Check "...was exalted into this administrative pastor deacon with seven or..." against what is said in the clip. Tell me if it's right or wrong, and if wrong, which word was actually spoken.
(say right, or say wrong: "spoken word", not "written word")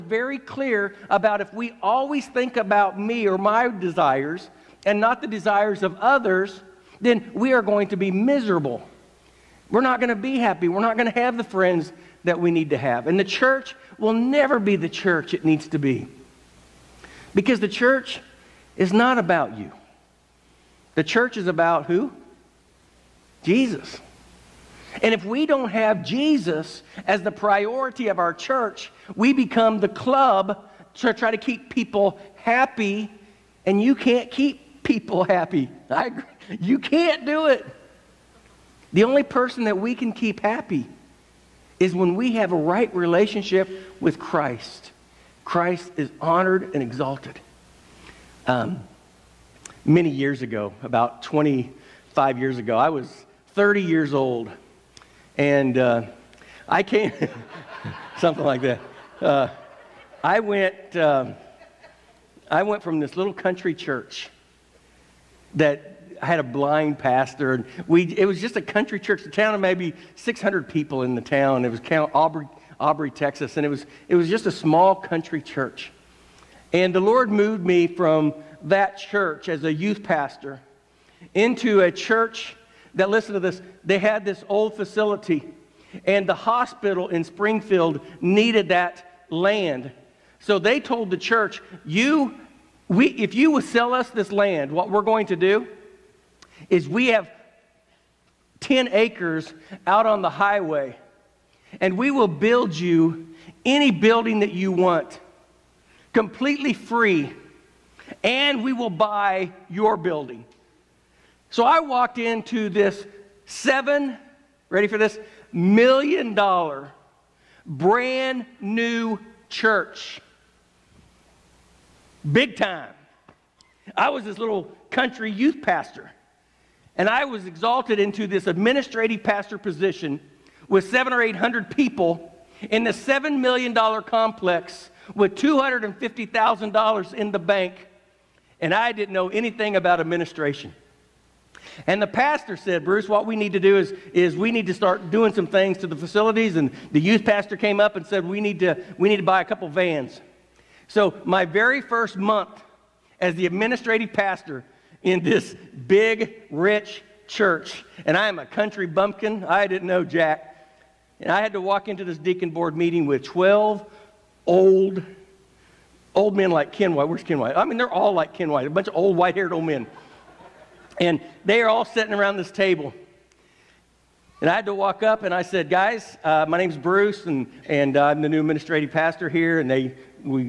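wrong: "position", not "deacon".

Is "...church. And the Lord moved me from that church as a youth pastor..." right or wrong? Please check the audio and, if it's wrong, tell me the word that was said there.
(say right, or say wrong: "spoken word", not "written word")
right.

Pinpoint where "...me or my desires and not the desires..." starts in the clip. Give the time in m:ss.
0:02.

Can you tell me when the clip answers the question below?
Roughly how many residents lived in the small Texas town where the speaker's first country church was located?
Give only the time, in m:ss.
1:10.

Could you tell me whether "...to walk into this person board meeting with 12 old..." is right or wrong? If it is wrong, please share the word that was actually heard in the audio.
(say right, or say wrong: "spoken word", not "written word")
wrong: "deacon", not "person".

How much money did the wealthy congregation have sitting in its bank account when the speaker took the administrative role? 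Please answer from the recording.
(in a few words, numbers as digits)
$250,000.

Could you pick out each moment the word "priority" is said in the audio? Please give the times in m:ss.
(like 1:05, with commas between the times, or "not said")
0:27.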